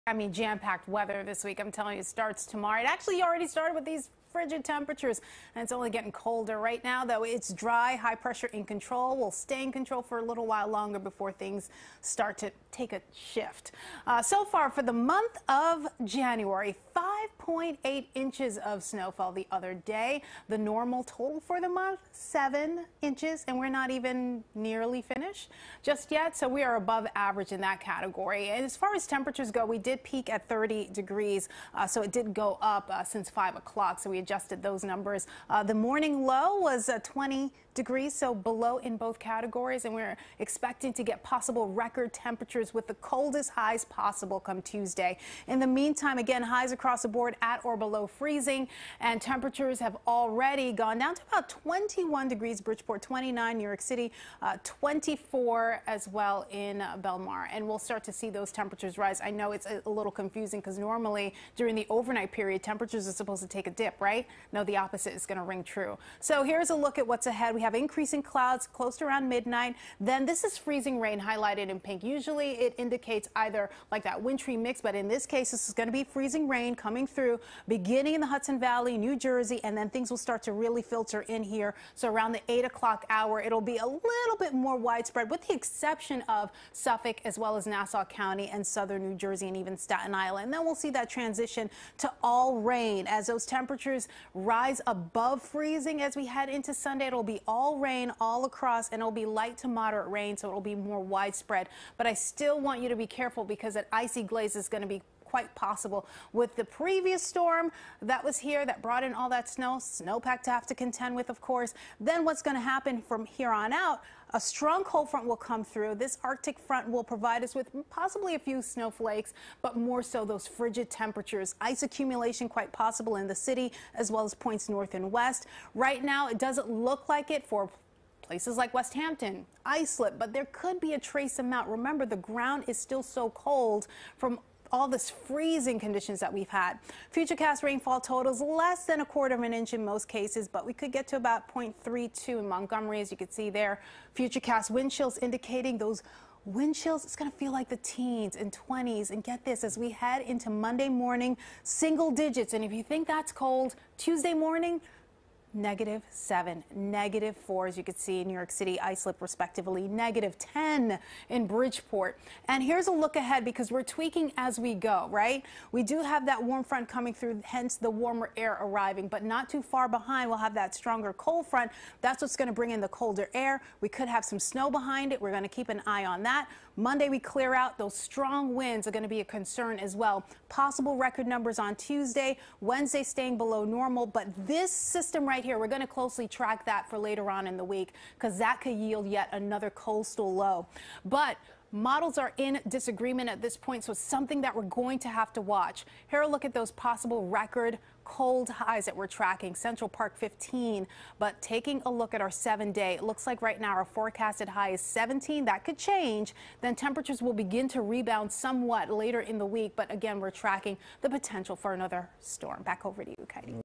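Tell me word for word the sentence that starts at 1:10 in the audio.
Then this is freezing rain highlighted in pink.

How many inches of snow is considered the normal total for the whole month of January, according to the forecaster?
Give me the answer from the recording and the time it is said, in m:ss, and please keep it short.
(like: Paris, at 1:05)
7 inches, at 0:22.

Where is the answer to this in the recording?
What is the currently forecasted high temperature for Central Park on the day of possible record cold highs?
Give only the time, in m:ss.
3:24.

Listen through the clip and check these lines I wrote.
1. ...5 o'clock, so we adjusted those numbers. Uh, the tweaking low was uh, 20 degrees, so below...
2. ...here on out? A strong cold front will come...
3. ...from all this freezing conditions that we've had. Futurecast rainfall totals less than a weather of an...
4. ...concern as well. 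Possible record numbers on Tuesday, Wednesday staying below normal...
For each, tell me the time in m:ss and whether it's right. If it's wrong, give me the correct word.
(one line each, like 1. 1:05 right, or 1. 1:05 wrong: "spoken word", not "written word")
1. 0:33 wrong: "morning", not "tweaking"
2. 1:53 right
3. 2:14 wrong: "quarter", not "weather"
4. 2:59 right.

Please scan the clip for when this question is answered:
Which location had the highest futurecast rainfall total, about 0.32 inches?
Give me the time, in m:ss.
2:22.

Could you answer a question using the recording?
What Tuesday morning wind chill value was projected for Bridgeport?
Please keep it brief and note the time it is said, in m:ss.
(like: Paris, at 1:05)
-10, at 2:39.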